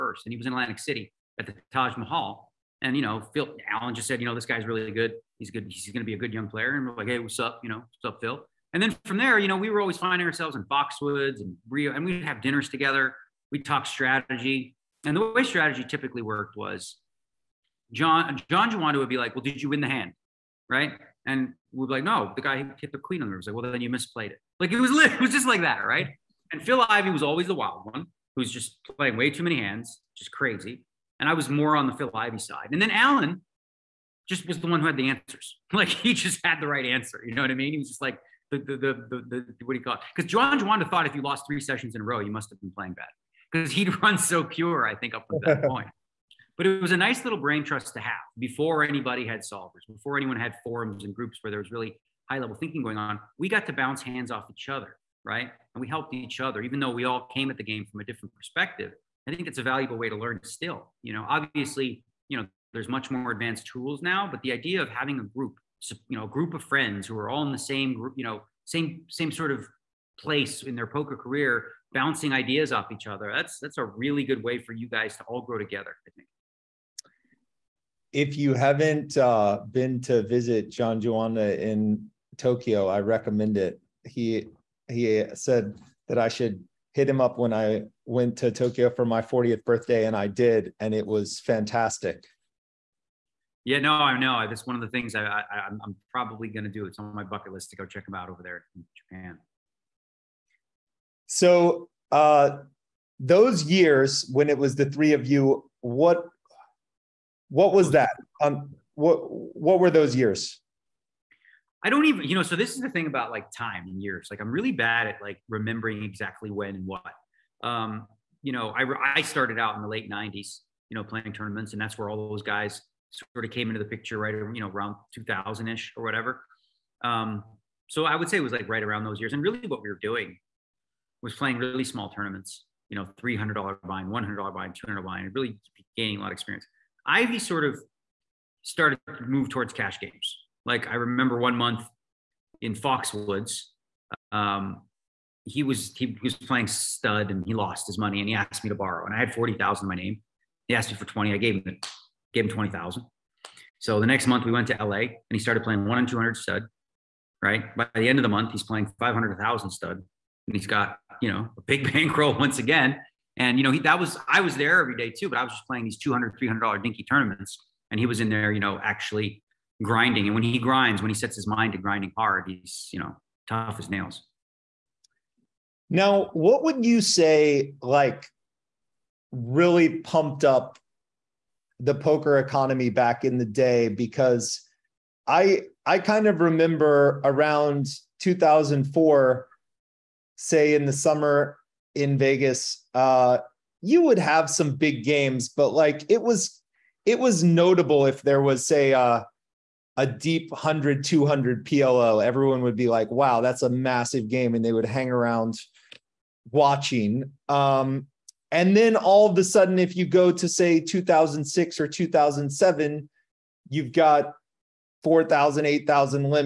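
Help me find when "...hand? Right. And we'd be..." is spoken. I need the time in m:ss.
0:19.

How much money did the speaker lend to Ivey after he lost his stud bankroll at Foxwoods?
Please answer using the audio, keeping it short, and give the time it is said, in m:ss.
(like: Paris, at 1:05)
$20,000, at 2:32.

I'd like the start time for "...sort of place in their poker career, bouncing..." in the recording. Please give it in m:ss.
1:09.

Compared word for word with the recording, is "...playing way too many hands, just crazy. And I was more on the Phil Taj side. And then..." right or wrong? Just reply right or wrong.
wrong.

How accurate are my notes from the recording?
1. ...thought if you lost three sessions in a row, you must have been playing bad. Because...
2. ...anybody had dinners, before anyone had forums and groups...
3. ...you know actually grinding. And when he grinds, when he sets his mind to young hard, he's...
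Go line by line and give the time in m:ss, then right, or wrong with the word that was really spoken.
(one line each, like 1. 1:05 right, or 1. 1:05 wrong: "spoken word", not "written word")
1. 0:40 right
2. 0:48 wrong: "solvers", not "dinners"
3. 2:48 wrong: "grinding", not "young".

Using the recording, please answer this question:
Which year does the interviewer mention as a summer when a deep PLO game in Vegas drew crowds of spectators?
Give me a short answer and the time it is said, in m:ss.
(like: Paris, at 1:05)
2004, at 3:08.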